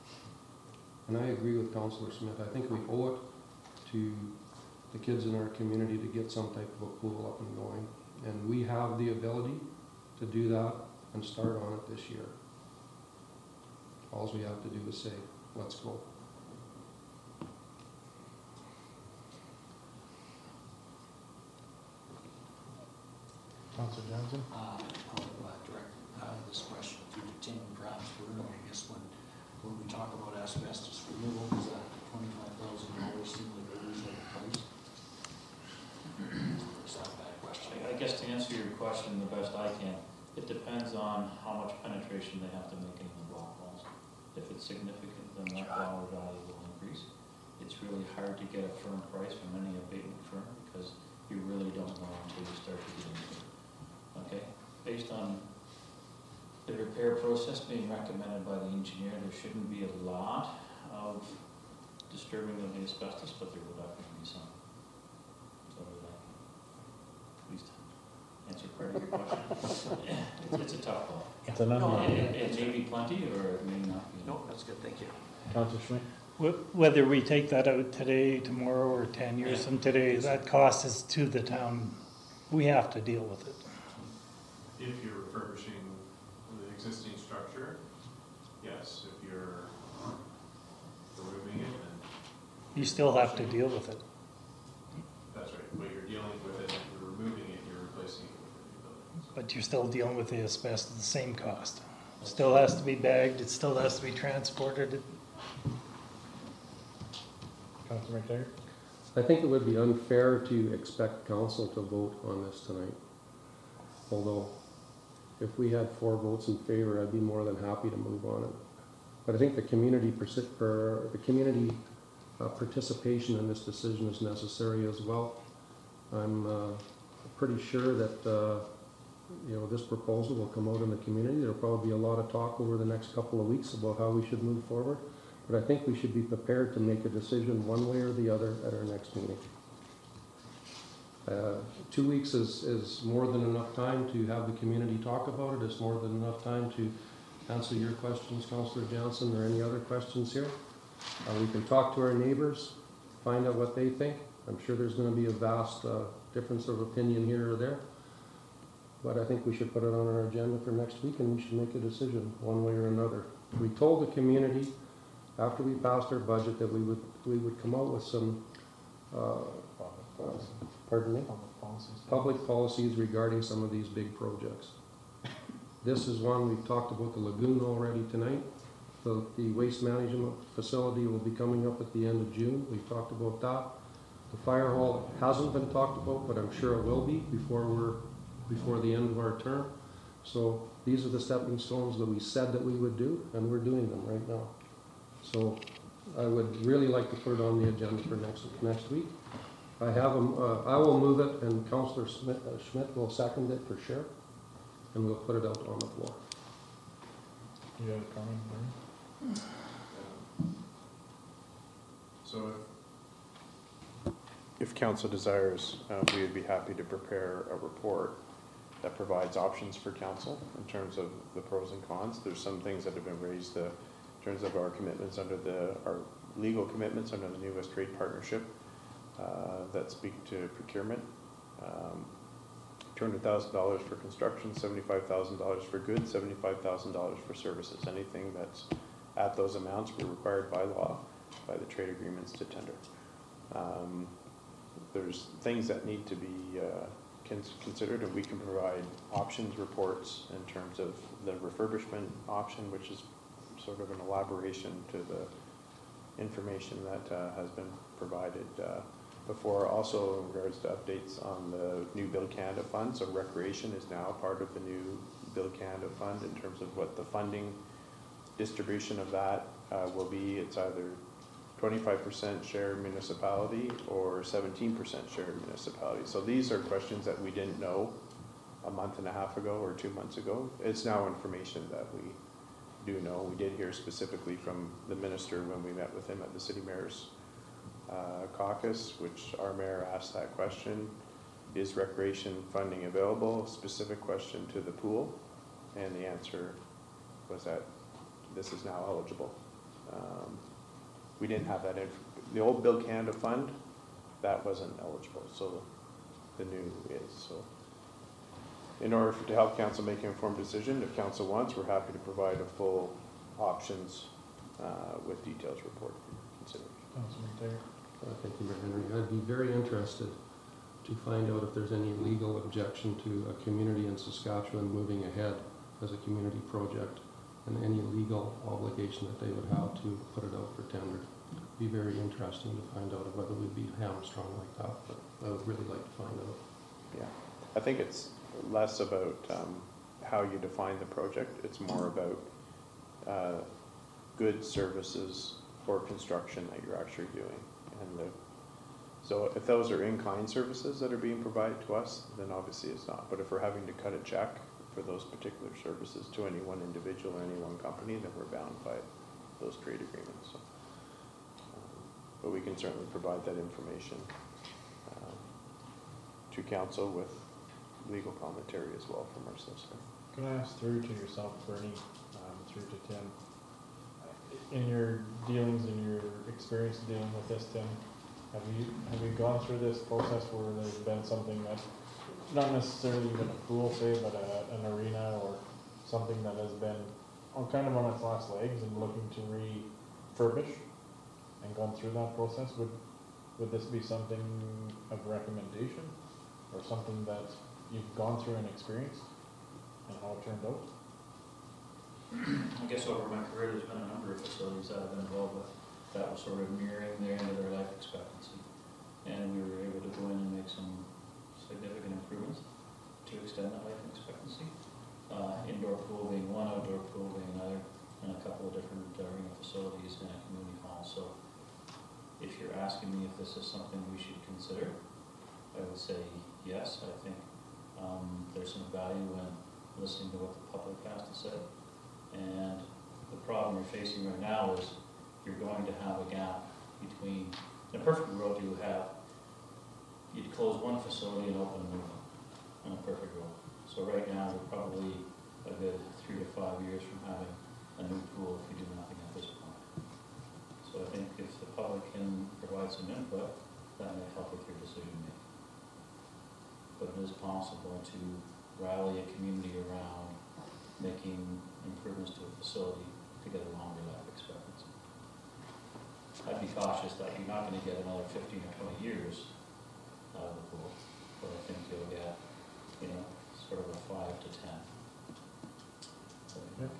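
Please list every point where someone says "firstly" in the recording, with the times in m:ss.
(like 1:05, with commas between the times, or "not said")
not said.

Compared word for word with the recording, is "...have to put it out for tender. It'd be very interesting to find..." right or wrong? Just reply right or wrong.
right.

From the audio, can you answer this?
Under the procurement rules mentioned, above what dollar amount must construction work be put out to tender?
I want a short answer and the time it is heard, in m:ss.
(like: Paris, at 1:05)
$200,000, at 3:52.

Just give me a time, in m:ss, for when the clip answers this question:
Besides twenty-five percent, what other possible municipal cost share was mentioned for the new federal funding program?
4:34.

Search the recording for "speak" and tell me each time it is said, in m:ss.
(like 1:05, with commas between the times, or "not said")
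3:49.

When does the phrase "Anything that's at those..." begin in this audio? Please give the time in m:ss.
3:57.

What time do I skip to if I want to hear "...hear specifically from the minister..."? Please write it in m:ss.
4:43.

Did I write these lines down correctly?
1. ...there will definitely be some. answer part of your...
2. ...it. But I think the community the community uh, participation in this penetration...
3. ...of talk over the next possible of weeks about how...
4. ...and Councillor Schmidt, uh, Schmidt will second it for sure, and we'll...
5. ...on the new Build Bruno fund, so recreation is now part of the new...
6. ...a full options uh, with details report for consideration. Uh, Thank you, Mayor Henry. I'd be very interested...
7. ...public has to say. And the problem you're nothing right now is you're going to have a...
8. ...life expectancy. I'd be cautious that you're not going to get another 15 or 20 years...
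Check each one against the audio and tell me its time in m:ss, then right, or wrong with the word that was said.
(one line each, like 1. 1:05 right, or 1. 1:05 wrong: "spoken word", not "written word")
1. 1:03 right
2. 1:58 wrong: "decision", not "penetration"
3. 2:12 wrong: "couple", not "possible"
4. 3:21 right
5. 4:21 wrong: "Canada", not "Bruno"
6. 5:12 right
7. 7:10 wrong: "facing", not "nothing"
8. 7:43 right.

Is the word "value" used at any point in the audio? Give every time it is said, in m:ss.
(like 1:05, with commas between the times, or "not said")
0:46, 7:08.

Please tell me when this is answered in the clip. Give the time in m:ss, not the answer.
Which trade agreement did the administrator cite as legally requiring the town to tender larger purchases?
3:47.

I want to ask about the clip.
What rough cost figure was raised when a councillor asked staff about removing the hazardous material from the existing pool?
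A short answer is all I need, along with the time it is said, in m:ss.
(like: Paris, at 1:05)
$25,000, at 0:32.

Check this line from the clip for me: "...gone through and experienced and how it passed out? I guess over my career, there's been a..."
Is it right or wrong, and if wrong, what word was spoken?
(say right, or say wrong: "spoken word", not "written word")
wrong: "turned", not "passed".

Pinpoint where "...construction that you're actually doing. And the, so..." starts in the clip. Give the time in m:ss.
5:45.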